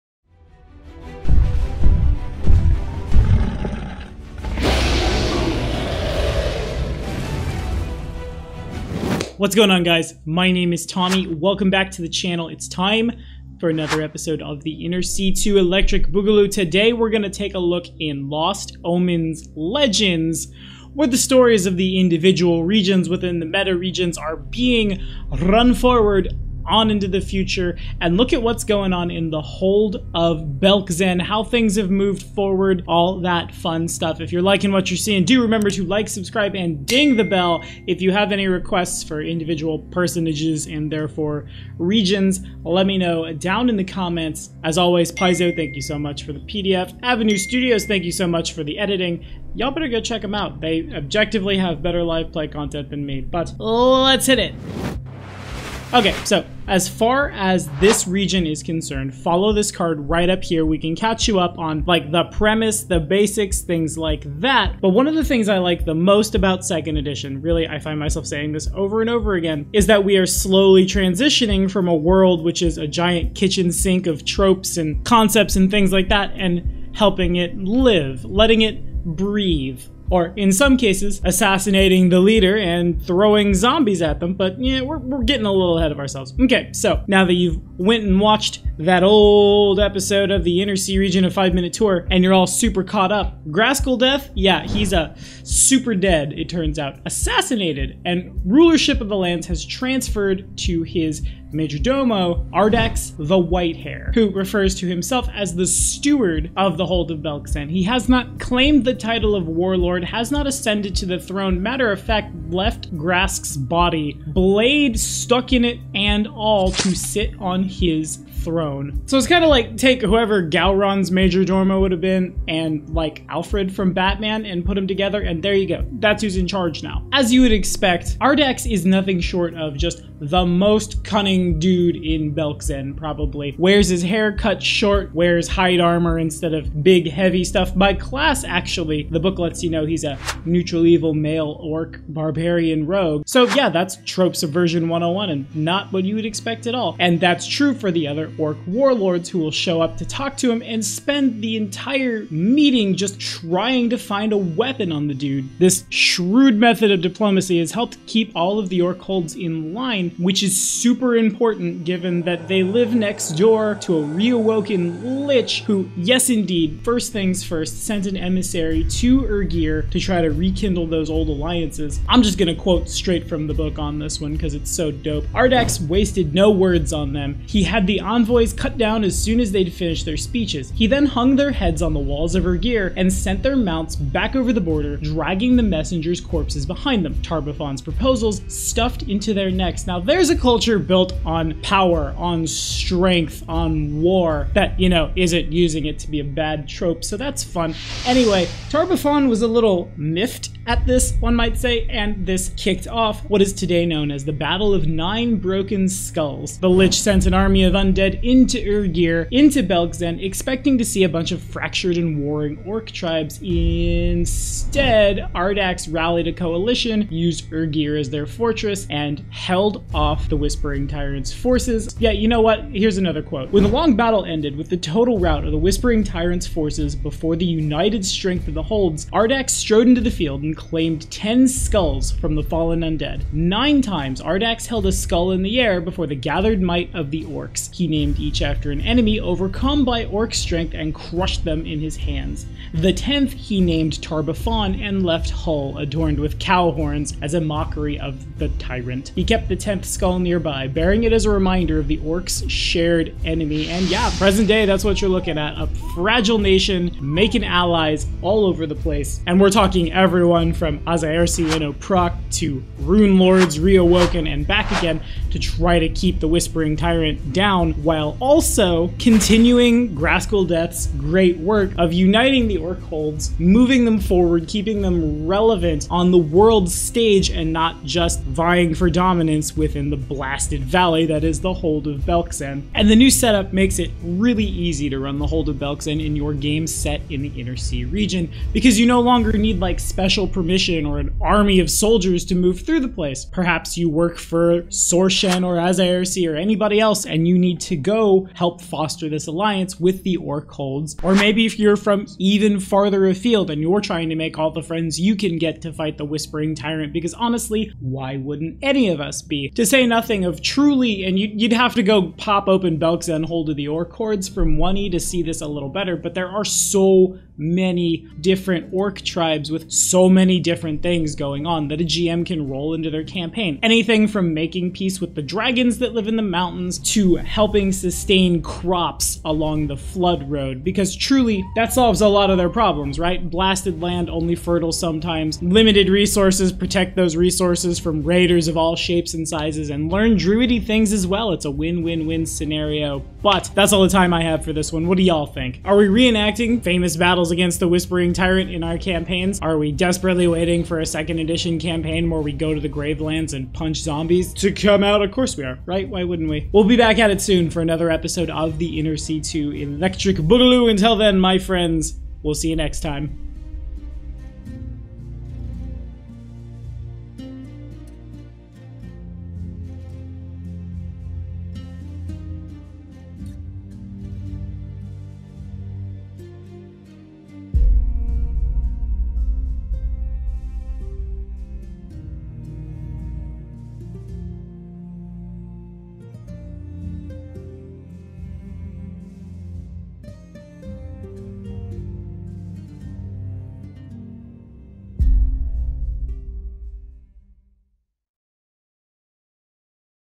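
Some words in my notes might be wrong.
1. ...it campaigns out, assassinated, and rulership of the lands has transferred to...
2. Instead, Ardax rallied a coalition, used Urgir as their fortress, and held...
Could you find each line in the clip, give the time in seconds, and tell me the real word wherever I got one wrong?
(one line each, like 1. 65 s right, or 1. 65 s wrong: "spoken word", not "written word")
1. 96 s wrong: "turns", not "campaigns"
2. 213 s right.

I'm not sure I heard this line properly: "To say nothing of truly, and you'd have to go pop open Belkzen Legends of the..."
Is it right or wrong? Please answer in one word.
wrong.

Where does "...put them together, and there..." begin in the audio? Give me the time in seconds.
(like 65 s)
124 s.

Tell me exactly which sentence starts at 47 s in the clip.
Avenue Studios, thank you so much for the editing.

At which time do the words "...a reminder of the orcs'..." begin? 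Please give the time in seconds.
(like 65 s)
251 s.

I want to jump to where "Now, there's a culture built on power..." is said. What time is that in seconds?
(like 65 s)
189 s.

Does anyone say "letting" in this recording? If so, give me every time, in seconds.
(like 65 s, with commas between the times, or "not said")
78 s.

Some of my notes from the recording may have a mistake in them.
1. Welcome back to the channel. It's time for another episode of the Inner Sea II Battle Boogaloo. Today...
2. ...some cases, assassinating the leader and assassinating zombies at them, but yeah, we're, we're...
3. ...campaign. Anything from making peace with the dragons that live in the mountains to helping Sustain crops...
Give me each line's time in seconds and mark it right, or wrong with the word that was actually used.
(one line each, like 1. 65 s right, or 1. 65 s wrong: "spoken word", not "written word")
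1. 11 s wrong: "Electric", not "Battle"
2. 80 s wrong: "throwing", not "assassinating"
3. 323 s right.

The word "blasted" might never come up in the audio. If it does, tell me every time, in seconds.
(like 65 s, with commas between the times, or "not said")
279 s, 333 s.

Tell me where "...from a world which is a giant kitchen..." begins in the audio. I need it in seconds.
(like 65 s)
71 s.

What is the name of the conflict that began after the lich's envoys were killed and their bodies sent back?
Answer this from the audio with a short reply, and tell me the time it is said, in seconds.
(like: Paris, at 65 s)
Battle of Nine Broken Skulls, at 204 s.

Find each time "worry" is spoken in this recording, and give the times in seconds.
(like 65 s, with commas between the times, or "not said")
not said.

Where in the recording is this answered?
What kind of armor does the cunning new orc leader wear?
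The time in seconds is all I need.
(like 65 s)
135 s.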